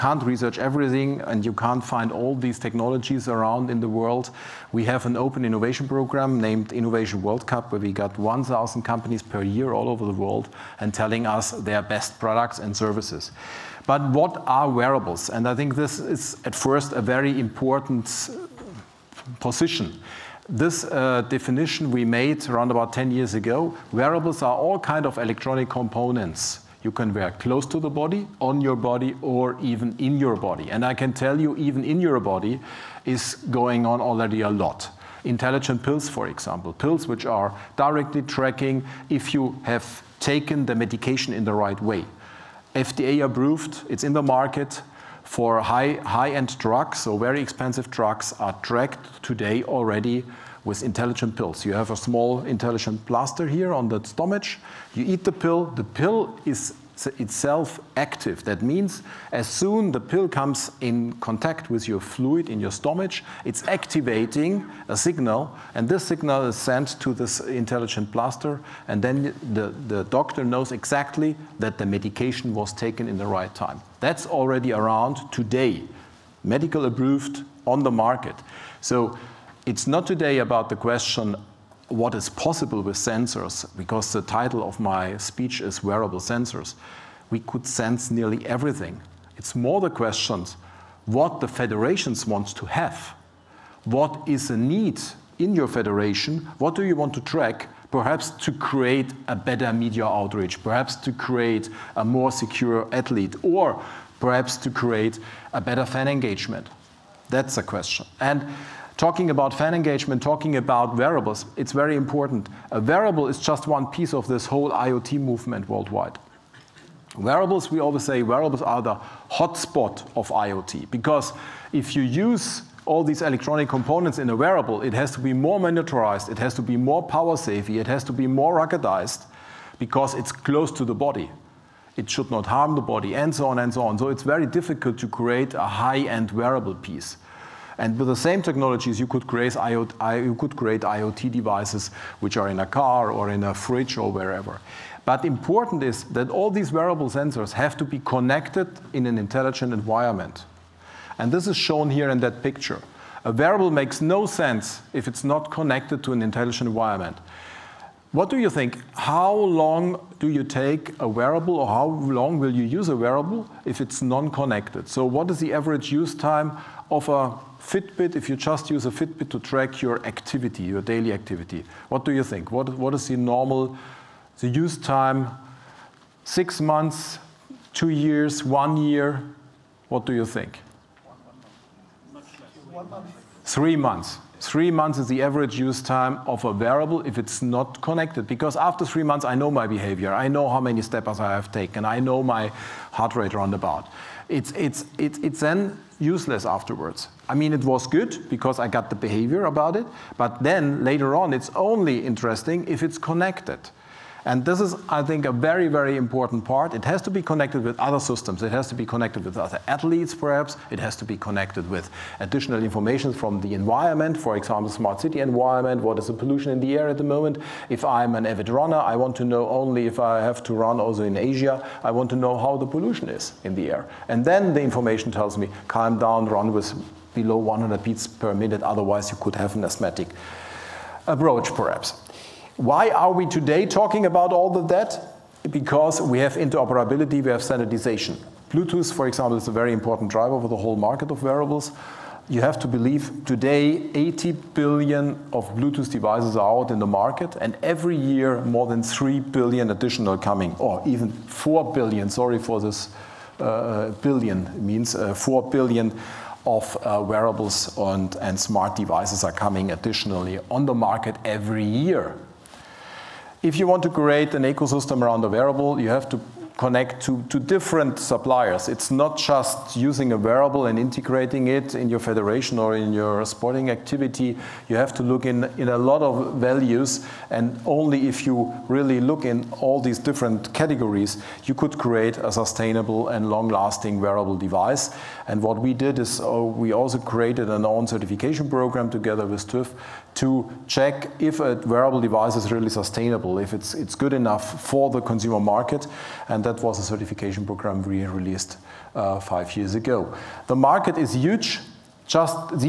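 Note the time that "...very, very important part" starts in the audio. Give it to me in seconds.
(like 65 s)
205 s.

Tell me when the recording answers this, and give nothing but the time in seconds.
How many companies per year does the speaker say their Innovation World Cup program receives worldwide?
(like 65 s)
8 s.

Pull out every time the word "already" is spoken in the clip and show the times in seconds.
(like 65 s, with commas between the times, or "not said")
34 s, 49 s, 74 s.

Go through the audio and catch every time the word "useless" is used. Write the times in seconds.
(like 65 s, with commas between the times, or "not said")
195 s.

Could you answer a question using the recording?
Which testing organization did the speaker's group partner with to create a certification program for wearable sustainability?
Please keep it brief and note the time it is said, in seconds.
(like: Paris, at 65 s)
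TÜV, at 289 s.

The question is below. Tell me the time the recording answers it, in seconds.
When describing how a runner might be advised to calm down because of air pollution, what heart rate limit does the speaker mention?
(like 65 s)
227 s.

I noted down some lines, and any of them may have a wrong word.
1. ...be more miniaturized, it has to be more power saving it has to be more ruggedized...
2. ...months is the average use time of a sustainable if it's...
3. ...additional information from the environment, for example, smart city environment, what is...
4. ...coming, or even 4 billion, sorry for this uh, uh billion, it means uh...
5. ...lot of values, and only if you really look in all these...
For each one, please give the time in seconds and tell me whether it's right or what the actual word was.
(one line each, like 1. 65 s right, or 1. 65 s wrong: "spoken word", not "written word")
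1. 125 s right
2. 184 s wrong: "wearable", not "sustainable"
3. 212 s right
4. 250 s right
5. 275 s right.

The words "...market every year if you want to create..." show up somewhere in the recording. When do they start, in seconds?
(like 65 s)
260 s.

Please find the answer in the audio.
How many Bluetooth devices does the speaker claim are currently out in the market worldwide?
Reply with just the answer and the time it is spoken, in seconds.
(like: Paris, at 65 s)
80 billion, at 243 s.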